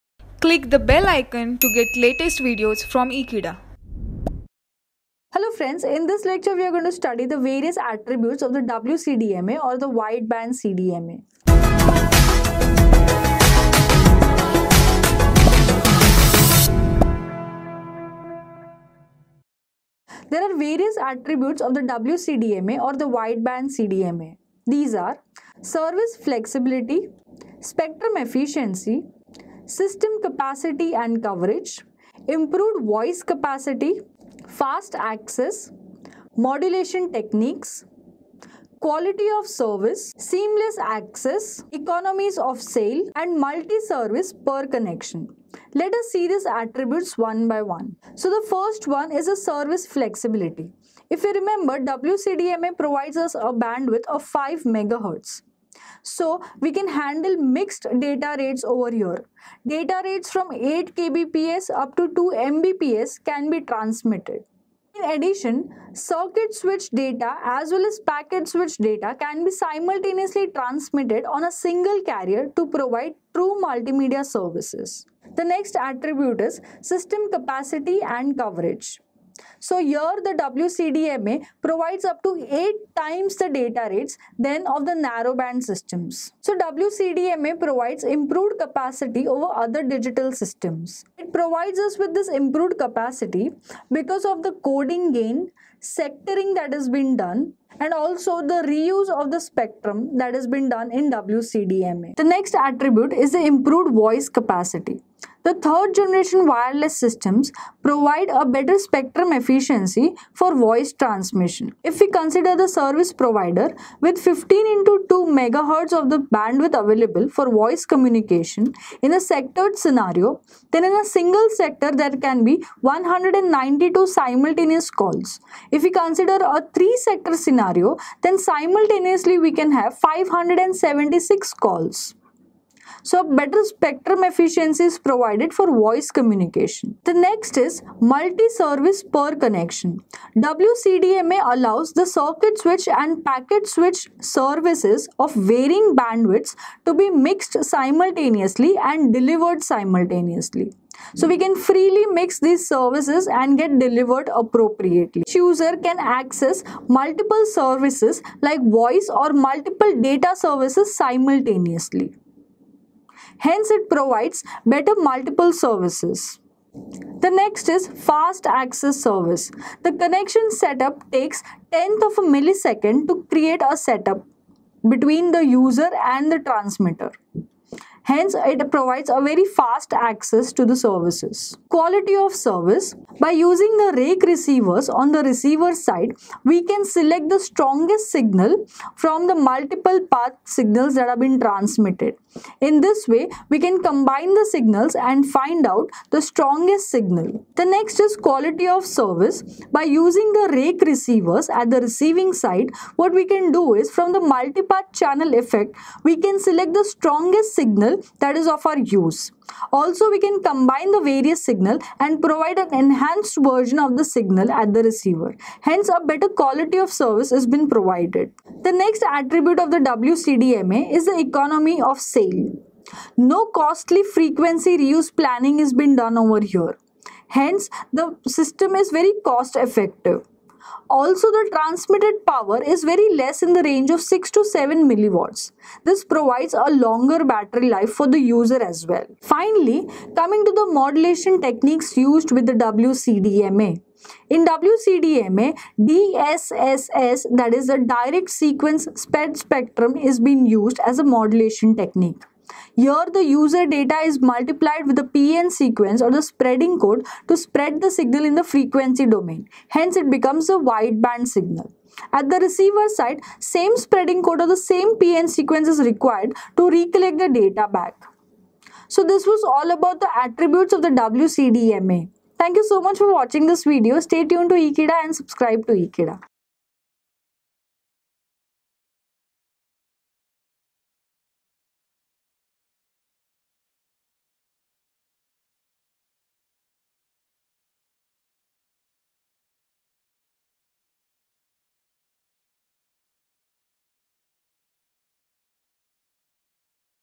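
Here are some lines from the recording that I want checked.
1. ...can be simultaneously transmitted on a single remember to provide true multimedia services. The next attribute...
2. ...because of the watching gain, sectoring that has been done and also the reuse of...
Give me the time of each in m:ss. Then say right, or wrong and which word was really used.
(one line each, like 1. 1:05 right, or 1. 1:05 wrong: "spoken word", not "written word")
1. 1:09 wrong: "carrier", not "remember"
2. 1:33 wrong: "coding", not "watching".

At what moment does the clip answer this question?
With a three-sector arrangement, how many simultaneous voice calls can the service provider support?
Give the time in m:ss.
2:09.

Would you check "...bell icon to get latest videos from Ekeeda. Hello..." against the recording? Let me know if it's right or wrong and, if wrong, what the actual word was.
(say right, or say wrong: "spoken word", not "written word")
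right.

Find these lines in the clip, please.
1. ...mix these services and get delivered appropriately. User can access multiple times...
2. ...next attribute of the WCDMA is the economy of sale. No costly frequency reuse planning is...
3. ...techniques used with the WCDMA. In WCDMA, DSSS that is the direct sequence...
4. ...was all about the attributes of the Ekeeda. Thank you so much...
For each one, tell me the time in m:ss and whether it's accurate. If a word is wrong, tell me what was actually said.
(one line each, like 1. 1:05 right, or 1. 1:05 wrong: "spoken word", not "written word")
1. 2:32 wrong: "services", not "times"
2. 3:38 right
3. 4:01 right
4. 4:29 wrong: "WCDMA", not "Ekeeda".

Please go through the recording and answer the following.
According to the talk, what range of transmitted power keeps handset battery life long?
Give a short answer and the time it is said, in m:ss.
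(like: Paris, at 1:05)
6 to 7 milliwatts, at 3:54.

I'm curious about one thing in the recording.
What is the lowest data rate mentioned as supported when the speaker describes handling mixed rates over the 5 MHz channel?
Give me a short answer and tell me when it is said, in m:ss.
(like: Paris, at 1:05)
8 kbps, at 1:00.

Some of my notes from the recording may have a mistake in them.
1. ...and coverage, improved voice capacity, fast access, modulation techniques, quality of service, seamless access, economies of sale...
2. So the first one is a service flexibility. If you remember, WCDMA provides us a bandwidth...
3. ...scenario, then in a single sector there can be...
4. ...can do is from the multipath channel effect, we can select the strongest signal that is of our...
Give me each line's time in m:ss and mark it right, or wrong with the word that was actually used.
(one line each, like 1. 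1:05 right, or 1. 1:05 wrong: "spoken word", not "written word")
1. 0:30 right
2. 0:48 right
3. 1:59 right
4. 3:23 right.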